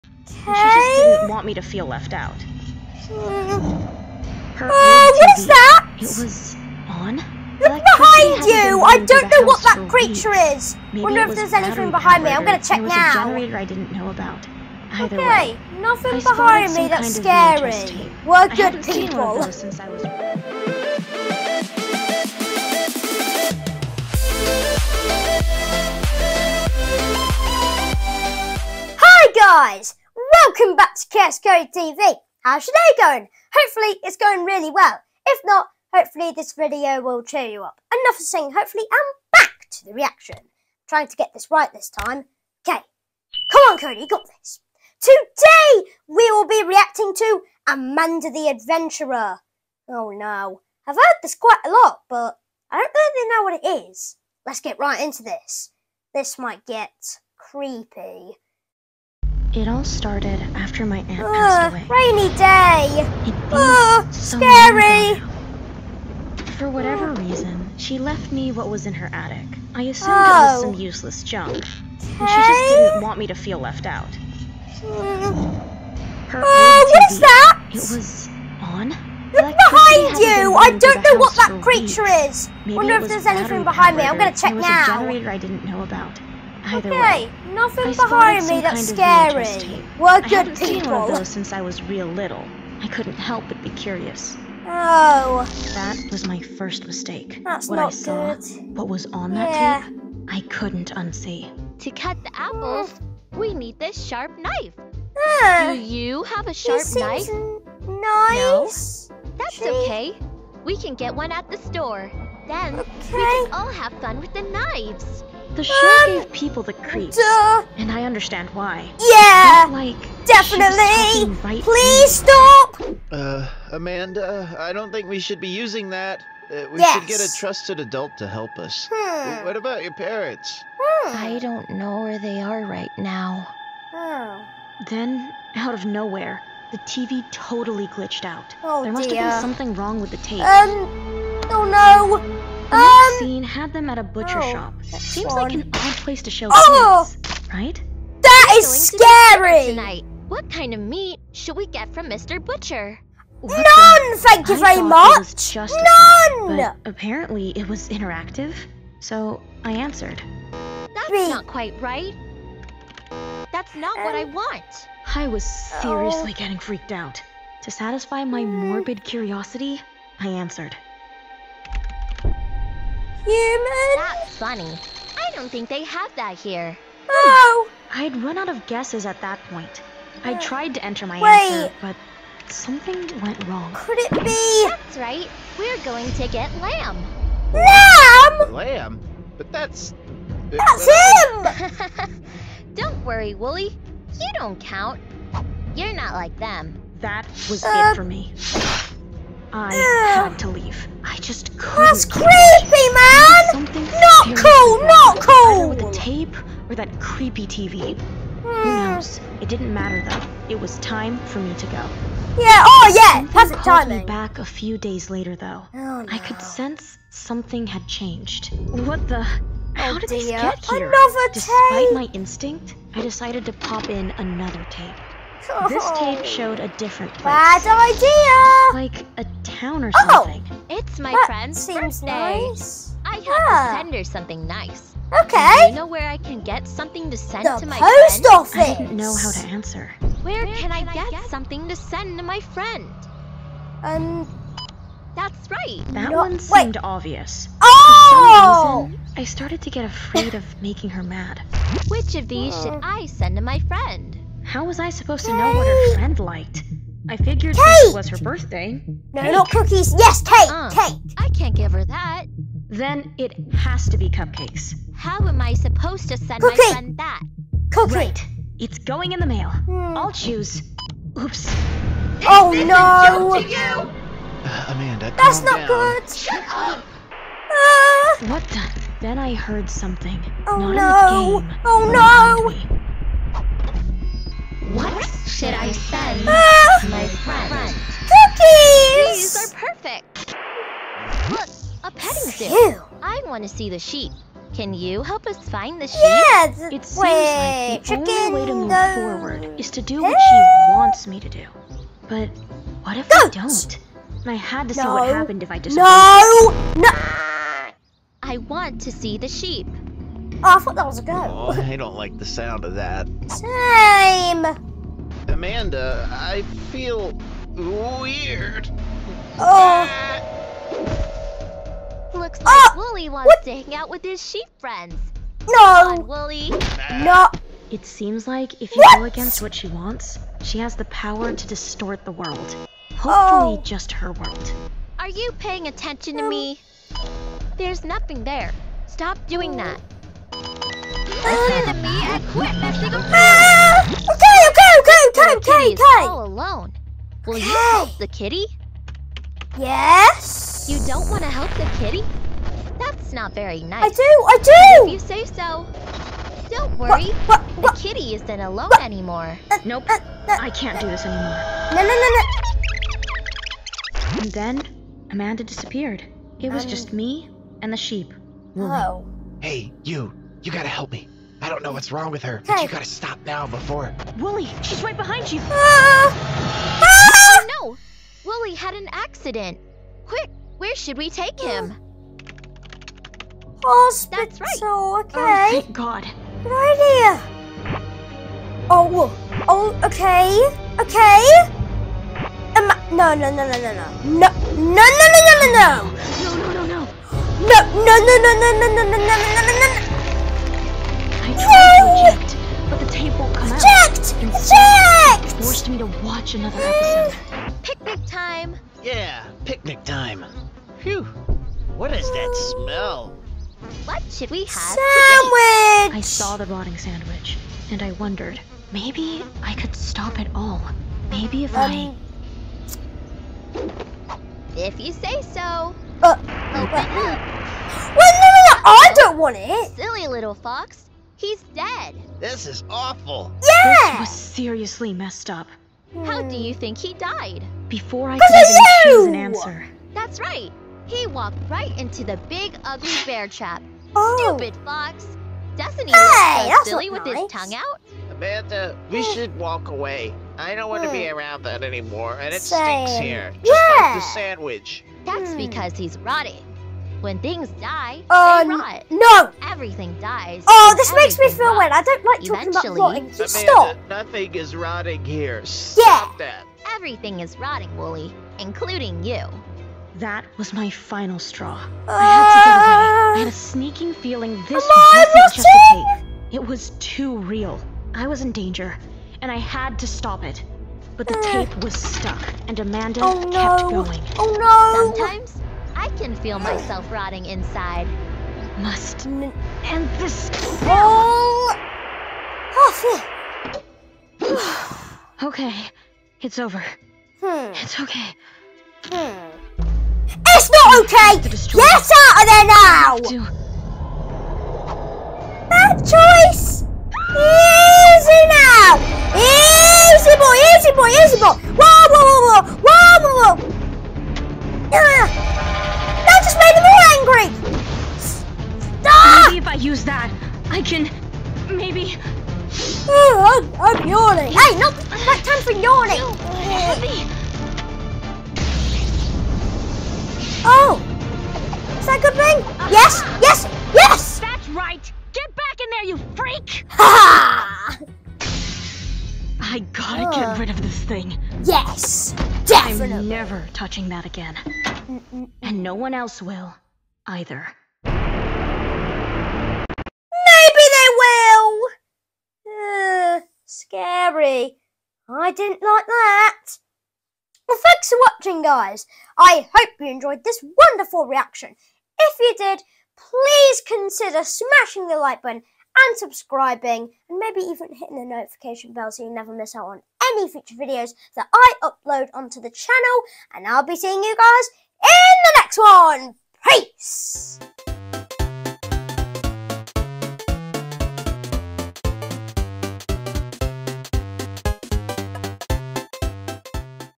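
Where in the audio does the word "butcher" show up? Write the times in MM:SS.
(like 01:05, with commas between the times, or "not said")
02:24, 02:32.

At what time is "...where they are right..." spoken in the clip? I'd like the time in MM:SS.
02:12.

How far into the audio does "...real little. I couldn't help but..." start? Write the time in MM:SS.
01:31.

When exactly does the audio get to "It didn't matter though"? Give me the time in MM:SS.
03:29.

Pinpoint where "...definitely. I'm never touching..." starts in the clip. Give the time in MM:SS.
09:02.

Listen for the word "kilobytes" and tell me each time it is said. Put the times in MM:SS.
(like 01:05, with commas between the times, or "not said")
not said.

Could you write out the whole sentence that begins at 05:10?
Oh, I thought that was a goat.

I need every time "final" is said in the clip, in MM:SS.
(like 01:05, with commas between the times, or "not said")
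07:50.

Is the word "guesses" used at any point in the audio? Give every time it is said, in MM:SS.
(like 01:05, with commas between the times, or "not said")
02:58.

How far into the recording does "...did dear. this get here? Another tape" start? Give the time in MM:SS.
03:39.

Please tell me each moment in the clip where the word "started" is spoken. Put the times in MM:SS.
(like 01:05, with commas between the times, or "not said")
00:59, 04:09.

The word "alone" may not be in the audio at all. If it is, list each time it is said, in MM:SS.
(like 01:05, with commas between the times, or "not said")
05:46, 05:58.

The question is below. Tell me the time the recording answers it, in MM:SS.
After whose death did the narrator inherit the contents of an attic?
01:00.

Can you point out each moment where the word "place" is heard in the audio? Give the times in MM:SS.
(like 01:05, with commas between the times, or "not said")
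02:26, 03:47.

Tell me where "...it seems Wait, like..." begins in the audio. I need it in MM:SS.
04:56.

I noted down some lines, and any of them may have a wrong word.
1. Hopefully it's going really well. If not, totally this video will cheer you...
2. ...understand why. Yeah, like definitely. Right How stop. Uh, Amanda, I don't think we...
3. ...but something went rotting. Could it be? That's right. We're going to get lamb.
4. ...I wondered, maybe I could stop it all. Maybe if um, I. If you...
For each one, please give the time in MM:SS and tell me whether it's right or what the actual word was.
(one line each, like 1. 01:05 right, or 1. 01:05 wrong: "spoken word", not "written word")
1. 00:33 wrong: "hopefully", not "totally"
2. 01:58 wrong: "Please", not "How"
3. 03:01 wrong: "wrong", not "rotting"
4. 06:57 right.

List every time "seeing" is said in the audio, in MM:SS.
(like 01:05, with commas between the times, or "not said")
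09:33.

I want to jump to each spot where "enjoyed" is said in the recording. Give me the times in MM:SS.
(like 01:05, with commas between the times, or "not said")
09:19.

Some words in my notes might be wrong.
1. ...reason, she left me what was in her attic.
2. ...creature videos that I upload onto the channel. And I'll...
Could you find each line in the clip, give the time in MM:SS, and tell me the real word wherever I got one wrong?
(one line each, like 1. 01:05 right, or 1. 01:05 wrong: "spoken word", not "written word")
1. 01:07 right
2. 09:30 wrong: "future", not "creature".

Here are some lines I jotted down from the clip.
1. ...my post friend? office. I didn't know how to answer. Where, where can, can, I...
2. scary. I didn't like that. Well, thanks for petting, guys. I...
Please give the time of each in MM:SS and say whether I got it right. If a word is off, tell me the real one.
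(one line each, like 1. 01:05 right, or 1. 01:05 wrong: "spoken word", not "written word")
1. 03:57 right
2. 09:13 wrong: "watching", not "petting".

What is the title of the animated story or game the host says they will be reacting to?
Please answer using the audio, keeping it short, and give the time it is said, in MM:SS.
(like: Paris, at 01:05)
Amanda the Adventurer, at 00:47.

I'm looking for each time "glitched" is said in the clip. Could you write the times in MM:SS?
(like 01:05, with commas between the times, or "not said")
02:17.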